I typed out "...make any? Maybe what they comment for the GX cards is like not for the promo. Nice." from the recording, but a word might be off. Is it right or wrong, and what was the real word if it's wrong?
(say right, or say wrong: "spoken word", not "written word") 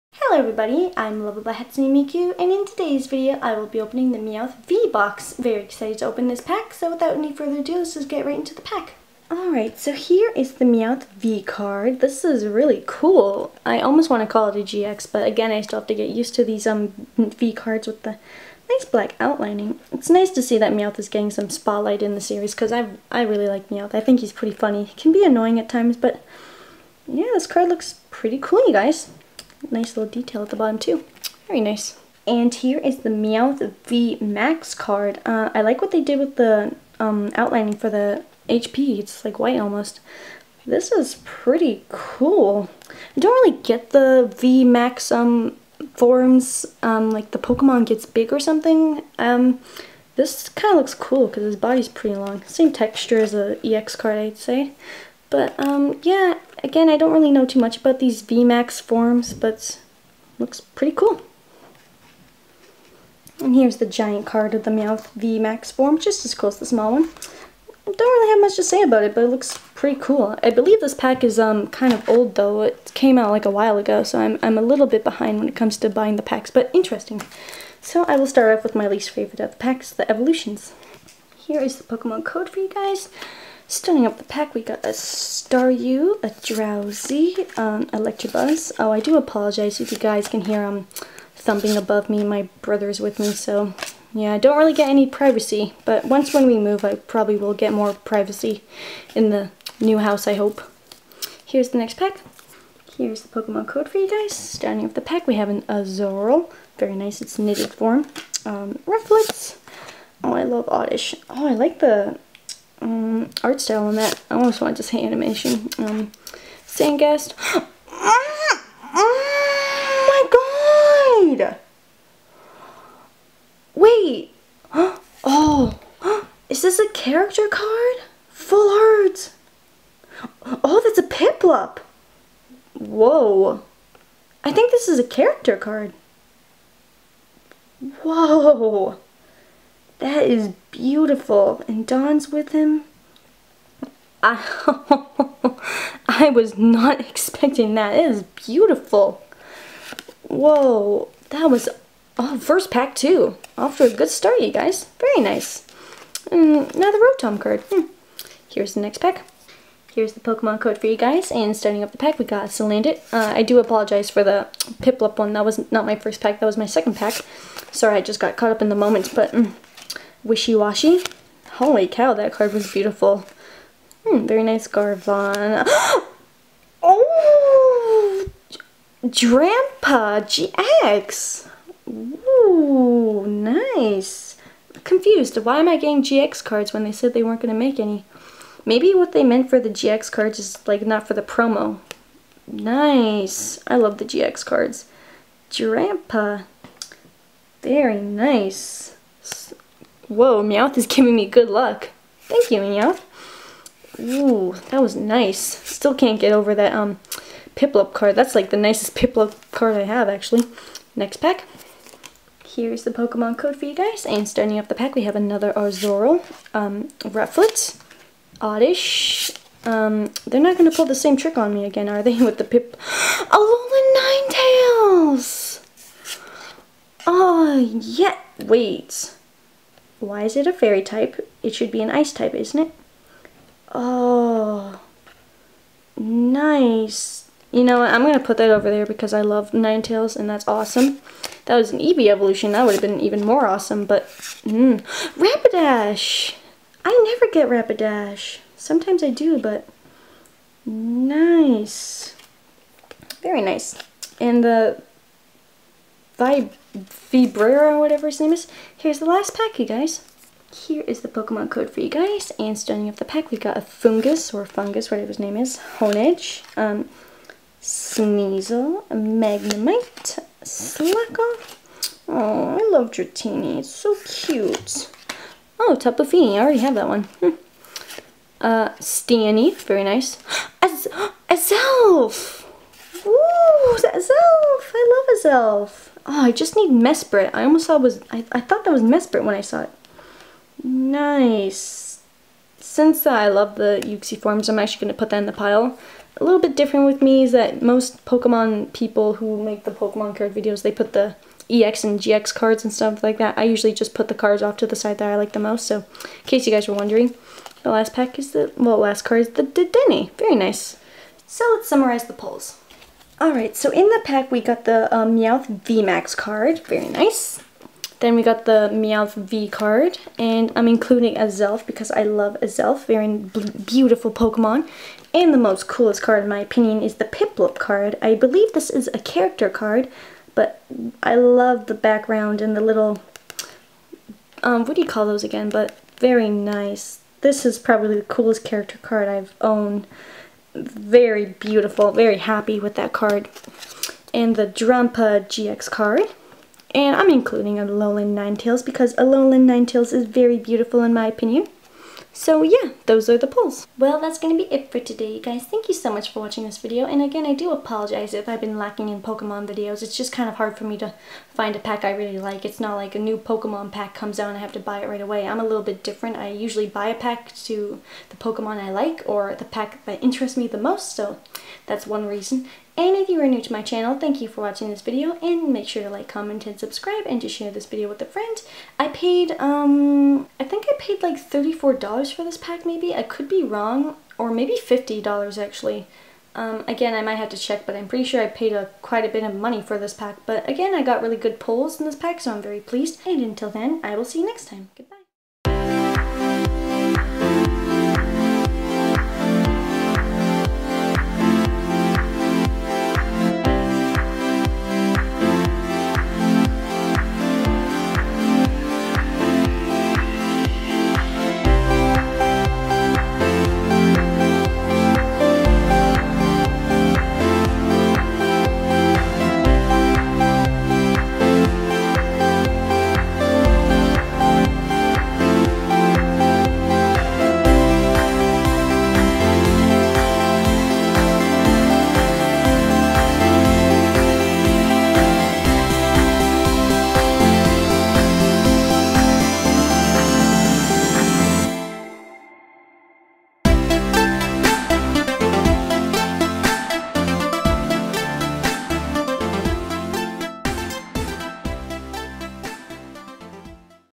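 wrong: "meant", not "comment".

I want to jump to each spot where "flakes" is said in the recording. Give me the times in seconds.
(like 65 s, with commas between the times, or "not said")
not said.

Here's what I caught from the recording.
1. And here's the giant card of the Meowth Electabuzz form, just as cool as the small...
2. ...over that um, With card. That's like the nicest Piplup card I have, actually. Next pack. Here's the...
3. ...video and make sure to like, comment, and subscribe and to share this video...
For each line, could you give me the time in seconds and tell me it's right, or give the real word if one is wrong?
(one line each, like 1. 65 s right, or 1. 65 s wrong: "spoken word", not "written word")
1. 63 s wrong: "VMAX", not "Electabuzz"
2. 206 s wrong: "Piplup", not "With"
3. 374 s right.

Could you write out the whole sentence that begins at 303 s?
I usually just put the cards off to the side that I like the most.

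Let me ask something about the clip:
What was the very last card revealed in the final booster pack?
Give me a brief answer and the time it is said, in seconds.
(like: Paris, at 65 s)
Dedenne, at 309 s.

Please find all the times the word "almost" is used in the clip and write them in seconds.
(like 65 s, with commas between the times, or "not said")
13 s, 39 s, 114 s, 287 s.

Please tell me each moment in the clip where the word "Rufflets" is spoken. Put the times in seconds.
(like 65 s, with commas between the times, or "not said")
108 s, 217 s.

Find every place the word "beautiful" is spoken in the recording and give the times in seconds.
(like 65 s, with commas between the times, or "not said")
140 s, 148 s, 172 s, 323 s, 341 s, 350 s.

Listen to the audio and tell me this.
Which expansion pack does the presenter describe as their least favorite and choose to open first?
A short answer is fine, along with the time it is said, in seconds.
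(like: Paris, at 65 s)
Evolutions, at 79 s.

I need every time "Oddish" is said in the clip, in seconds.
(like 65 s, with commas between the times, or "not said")
110 s, 218 s.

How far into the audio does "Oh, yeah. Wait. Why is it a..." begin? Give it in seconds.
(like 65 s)
227 s.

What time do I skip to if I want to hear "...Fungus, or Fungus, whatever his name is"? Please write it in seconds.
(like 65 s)
263 s.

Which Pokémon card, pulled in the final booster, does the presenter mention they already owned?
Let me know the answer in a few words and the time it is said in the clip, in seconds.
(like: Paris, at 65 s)
Tapu Fini, at 275 s.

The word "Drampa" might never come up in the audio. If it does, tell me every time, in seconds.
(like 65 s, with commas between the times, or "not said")
179 s, 195 s, 344 s.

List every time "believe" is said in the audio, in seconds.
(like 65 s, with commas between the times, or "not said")
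70 s, 328 s.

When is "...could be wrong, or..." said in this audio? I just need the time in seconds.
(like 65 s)
383 s.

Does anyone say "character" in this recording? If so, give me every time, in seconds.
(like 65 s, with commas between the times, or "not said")
126 s, 135 s, 328 s, 338 s.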